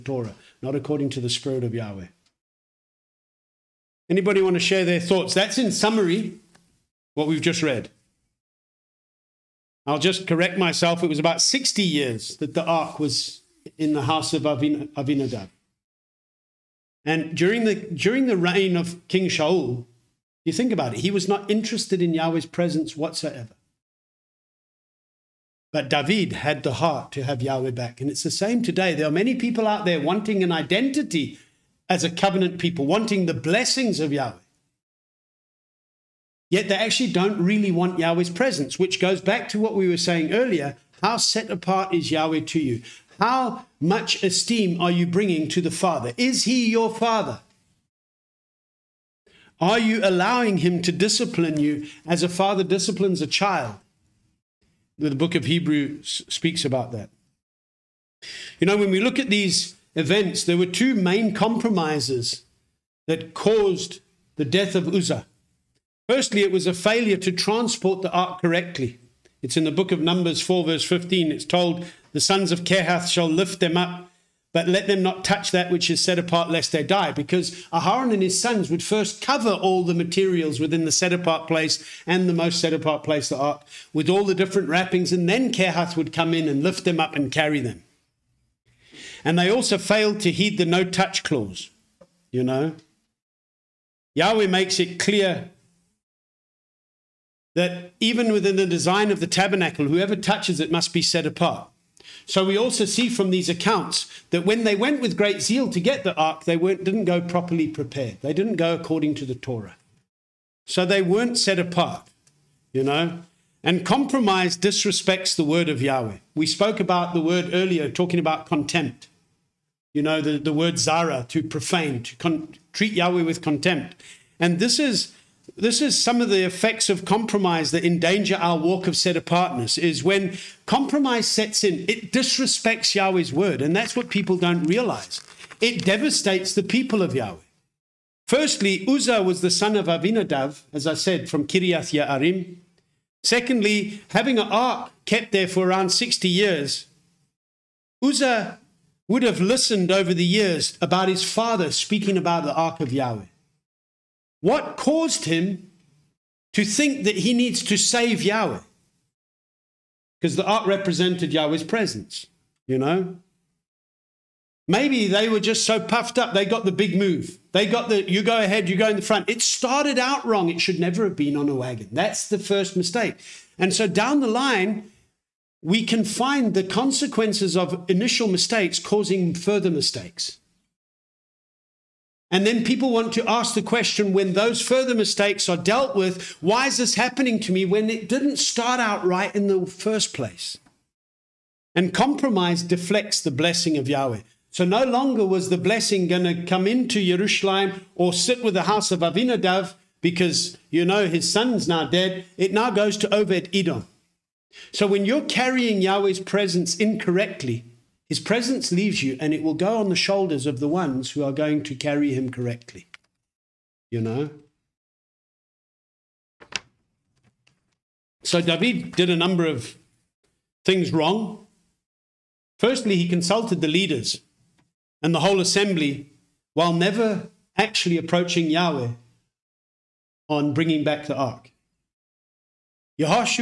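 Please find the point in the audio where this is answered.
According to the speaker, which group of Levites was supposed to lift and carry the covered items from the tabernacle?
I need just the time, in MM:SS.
01:12.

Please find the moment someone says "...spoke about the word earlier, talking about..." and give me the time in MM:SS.
01:56.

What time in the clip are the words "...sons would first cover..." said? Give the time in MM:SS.
01:18.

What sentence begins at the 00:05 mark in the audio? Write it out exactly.
That's in summary what we've just read.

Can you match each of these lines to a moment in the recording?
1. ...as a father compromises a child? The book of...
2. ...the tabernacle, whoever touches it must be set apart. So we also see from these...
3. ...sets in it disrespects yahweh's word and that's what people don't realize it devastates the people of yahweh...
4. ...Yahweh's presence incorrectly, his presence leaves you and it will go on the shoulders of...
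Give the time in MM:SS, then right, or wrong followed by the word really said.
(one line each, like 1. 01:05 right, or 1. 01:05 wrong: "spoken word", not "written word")
1. 00:52 wrong: "disciplines", not "compromises"
2. 01:39 right
3. 02:11 right
4. 03:25 right.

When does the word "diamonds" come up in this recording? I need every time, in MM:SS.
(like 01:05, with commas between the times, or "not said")
not said.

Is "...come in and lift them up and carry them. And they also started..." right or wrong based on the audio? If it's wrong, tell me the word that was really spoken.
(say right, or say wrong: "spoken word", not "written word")
wrong: "failed", not "started".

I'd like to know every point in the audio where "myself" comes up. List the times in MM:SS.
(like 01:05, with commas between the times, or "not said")
00:10.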